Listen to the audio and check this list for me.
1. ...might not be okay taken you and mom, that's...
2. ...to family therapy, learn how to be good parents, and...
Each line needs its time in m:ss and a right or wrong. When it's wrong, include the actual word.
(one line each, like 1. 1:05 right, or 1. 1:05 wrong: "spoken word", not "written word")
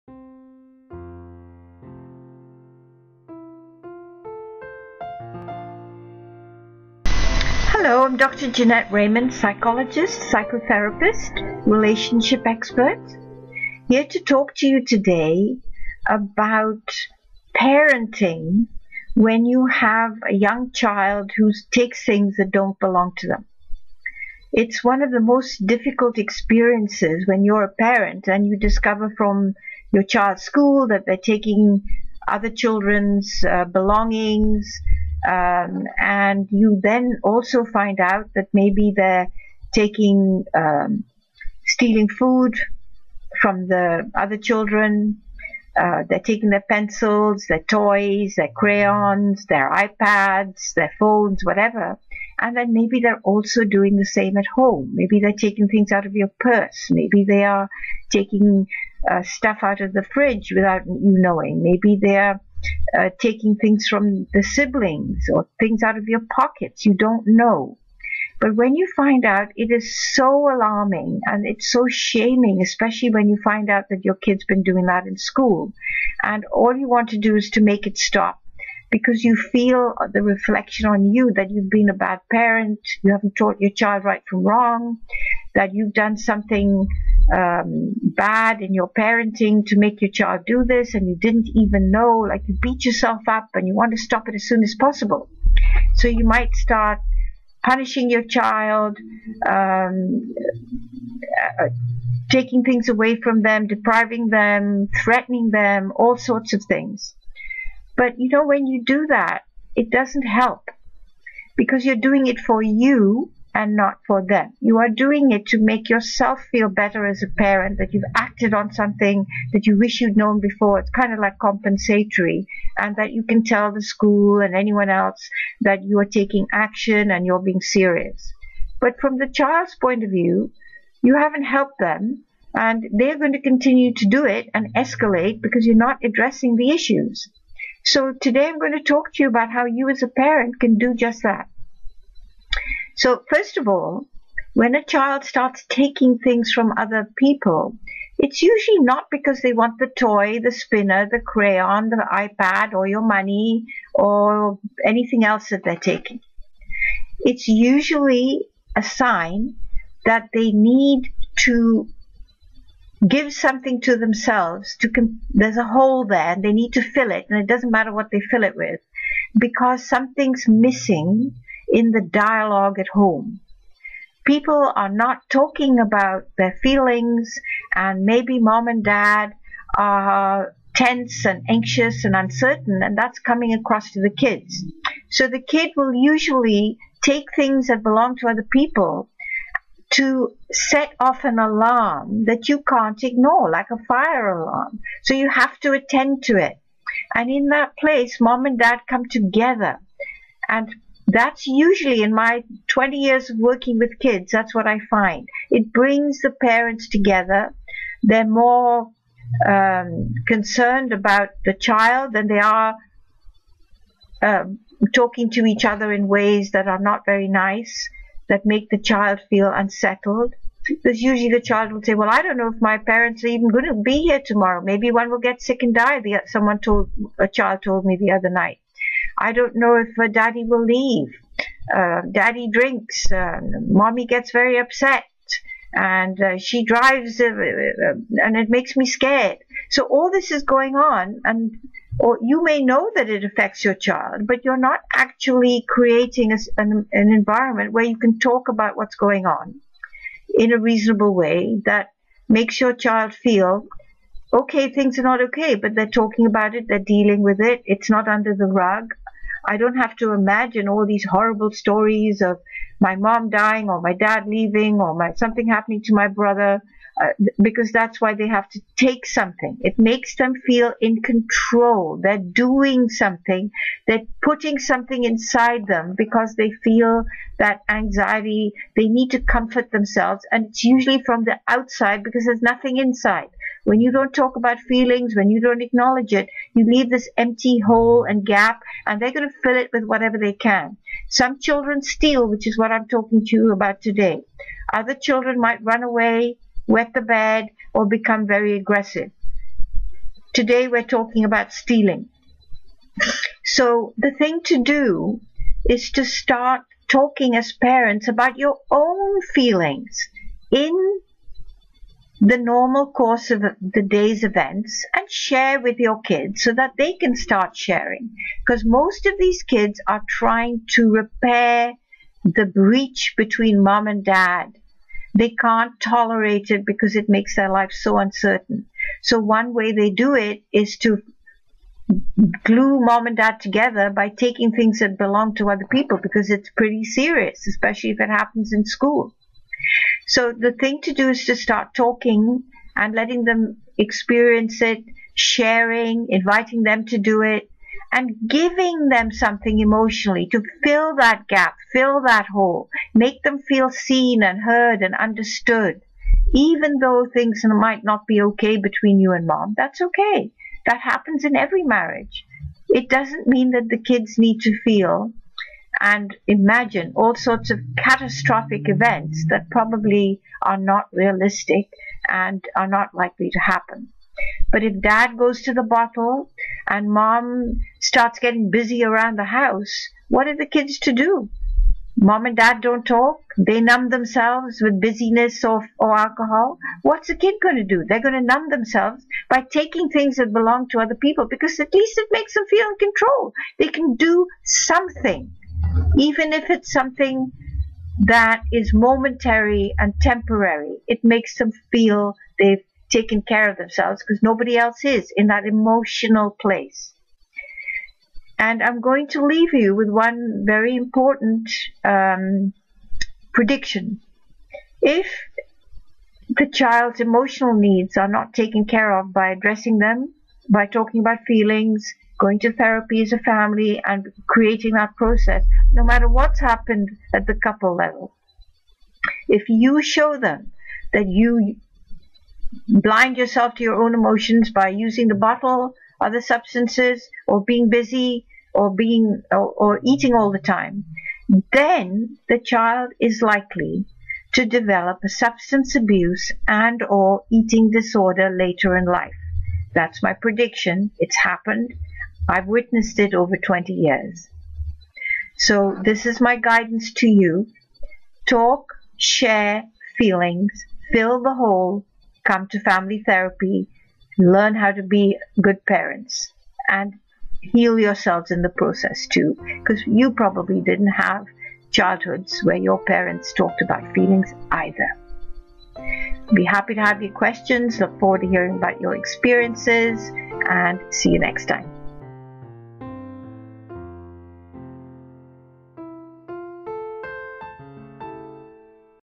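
1. 5:57 wrong: "between", not "taken"
2. 7:42 right.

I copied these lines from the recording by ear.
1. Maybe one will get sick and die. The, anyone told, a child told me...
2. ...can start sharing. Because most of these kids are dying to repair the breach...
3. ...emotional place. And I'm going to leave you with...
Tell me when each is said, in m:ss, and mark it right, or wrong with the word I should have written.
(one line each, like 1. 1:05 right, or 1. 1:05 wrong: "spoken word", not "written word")
1. 3:44 wrong: "someone", not "anyone"
2. 5:16 wrong: "trying", not "dying"
3. 6:45 right.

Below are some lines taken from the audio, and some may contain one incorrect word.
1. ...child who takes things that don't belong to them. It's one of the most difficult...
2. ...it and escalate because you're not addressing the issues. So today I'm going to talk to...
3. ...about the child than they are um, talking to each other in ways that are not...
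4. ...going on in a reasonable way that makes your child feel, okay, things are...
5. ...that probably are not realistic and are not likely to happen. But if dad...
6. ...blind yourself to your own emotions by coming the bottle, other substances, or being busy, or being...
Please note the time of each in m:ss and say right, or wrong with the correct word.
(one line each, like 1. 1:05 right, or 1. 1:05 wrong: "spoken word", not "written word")
1. 0:20 right
2. 2:14 right
3. 3:30 right
4. 4:08 right
5. 6:09 right
6. 7:12 wrong: "using", not "coming".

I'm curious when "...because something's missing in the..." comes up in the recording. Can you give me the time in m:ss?
2:49.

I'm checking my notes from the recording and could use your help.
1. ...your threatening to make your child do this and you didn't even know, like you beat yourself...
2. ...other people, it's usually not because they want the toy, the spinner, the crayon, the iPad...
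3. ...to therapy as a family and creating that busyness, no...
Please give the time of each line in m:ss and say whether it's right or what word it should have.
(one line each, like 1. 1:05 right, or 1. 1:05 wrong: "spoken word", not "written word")
1. 1:28 wrong: "parenting", not "threatening"
2. 2:26 right
3. 7:02 wrong: "process", not "busyness".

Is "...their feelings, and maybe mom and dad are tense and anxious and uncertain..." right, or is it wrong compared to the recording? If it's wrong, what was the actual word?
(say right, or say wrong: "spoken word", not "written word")
right.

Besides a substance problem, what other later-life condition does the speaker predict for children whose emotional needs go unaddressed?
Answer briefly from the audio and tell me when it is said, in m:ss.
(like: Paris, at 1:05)
eating disorder, at 7:27.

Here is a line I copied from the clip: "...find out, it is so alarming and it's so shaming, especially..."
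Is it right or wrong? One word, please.
right.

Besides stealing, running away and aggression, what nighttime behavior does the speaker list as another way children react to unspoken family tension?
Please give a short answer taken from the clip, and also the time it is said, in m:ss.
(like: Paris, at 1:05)
wet the bed, at 4:56.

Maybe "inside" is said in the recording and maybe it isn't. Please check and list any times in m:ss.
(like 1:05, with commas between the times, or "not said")
4:35, 4:42.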